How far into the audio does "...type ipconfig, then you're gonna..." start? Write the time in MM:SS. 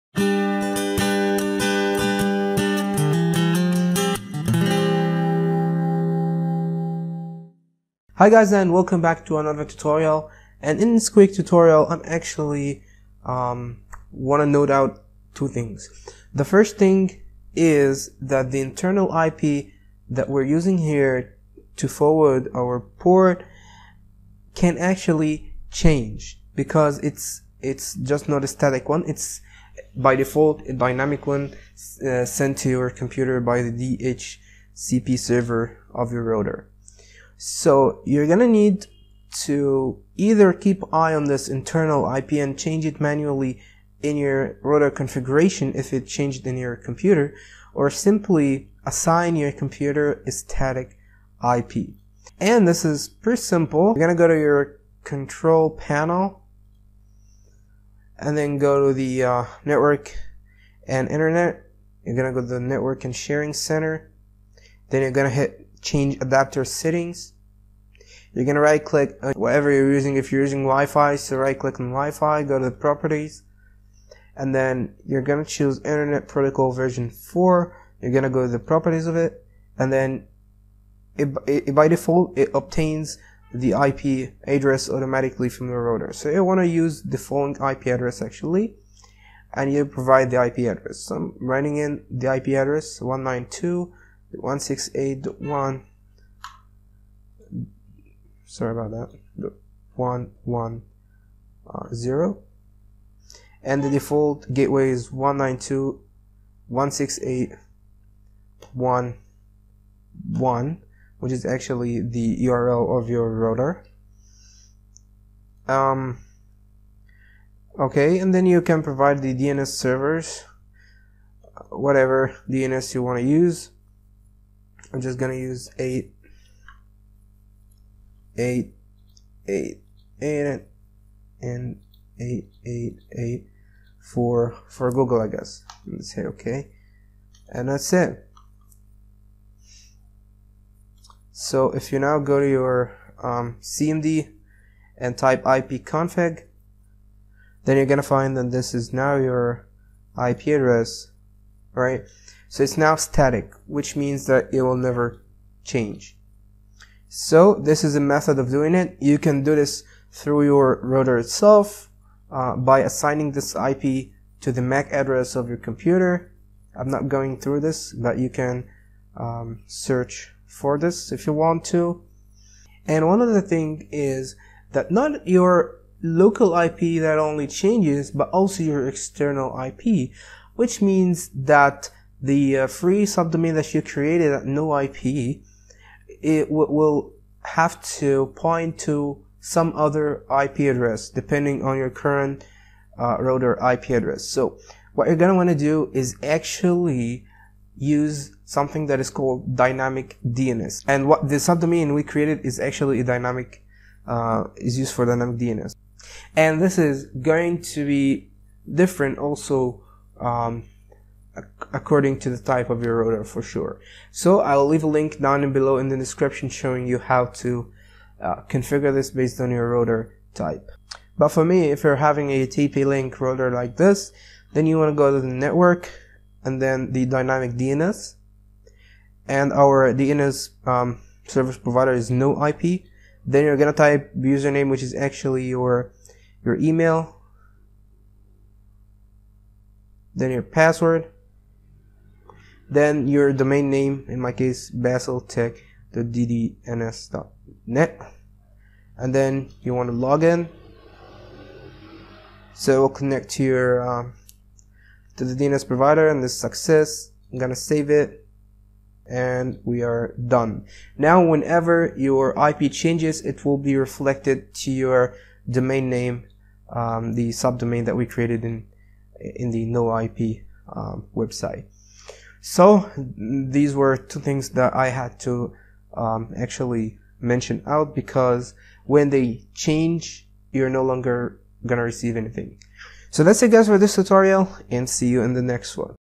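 02:25.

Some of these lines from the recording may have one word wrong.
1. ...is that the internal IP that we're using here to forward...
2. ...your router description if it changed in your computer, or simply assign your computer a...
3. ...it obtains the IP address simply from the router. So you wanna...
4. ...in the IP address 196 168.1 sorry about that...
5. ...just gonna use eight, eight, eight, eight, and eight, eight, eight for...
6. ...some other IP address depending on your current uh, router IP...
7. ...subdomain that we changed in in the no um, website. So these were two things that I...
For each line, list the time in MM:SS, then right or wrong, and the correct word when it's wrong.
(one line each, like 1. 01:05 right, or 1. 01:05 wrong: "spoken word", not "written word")
1. 00:17 right
2. 00:44 wrong: "configuration", not "description"
3. 01:22 wrong: "automatically", not "simply"
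4. 01:31 wrong: "192", not "196"
5. 02:05 right
6. 03:09 right
7. 04:27 wrong: "created", not "changed".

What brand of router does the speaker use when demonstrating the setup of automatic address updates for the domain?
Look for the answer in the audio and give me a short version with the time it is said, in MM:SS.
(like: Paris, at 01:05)
TP-Link, at 03:42.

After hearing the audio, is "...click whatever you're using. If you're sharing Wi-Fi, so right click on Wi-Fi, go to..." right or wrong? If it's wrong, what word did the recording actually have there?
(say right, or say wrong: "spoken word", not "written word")
wrong: "using", not "sharing".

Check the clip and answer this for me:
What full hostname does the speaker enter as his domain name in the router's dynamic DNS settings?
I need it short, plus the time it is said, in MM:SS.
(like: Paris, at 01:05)
basseltech.ddns.net, at 04:04.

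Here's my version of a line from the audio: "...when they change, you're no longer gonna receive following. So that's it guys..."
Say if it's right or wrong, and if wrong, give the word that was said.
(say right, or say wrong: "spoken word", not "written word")
wrong: "anything", not "following".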